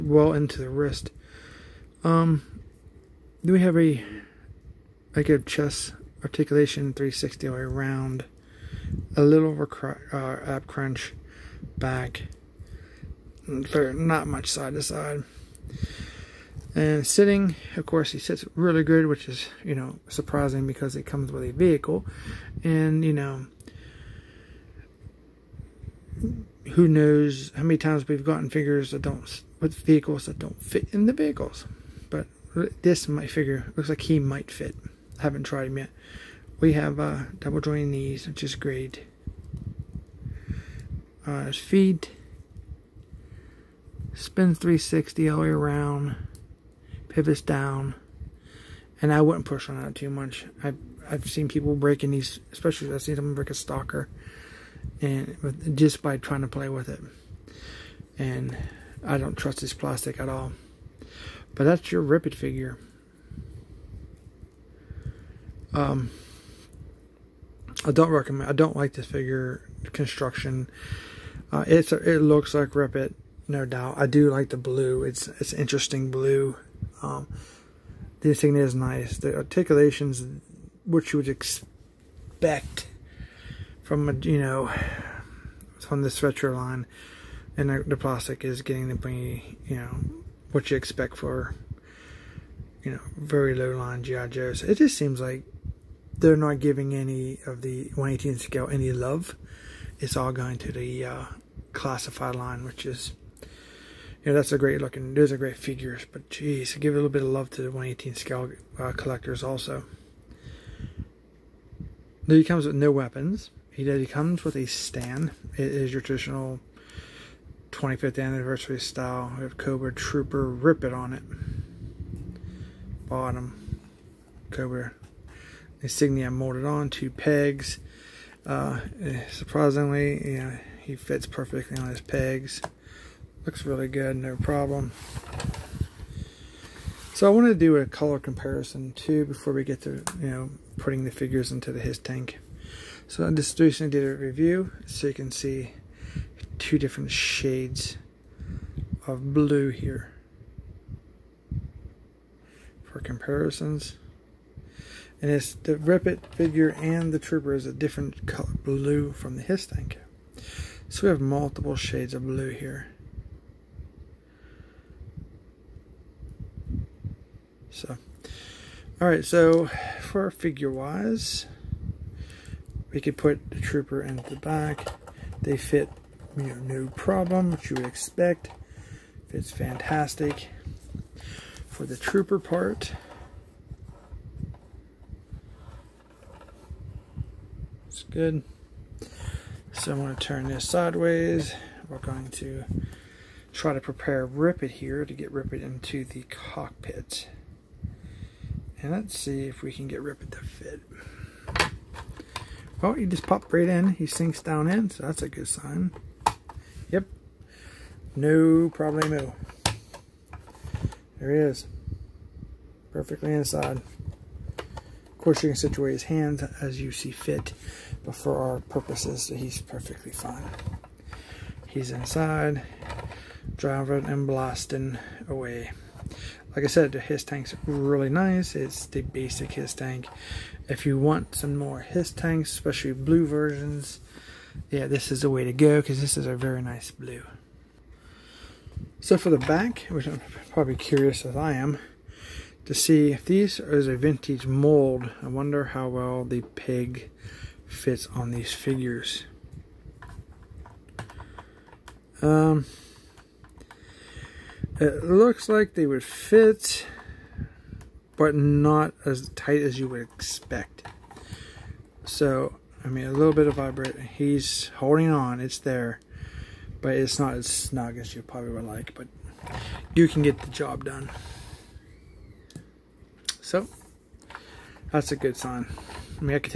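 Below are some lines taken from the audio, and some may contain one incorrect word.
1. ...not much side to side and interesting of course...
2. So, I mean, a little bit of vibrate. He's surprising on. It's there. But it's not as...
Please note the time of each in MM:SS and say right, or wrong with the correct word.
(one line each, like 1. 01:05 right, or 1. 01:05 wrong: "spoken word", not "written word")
1. 00:13 wrong: "sitting", not "interesting"
2. 04:22 wrong: "holding", not "surprising".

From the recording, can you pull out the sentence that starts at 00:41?
Uh, his feet spins 360 all the way around, pivots down, and I wouldn't push on that too much.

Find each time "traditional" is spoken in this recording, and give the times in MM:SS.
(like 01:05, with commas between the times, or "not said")
01:56.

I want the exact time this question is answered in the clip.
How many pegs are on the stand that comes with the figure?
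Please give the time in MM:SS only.
02:06.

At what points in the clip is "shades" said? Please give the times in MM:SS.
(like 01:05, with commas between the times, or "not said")
02:27, 02:41.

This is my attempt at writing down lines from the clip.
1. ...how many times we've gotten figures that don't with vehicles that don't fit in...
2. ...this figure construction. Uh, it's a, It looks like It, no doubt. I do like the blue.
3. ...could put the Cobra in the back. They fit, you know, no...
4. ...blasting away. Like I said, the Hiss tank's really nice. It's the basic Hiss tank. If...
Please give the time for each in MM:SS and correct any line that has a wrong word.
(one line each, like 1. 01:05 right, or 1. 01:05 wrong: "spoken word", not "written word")
1. 00:27 right
2. 01:08 right
3. 02:53 wrong: "Trooper", not "Cobra"
4. 03:44 right.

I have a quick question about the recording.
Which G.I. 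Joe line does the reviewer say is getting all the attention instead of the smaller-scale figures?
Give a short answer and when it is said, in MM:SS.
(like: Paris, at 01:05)
Classified line, at 01:41.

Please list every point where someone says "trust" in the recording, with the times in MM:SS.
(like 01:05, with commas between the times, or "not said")
00:59.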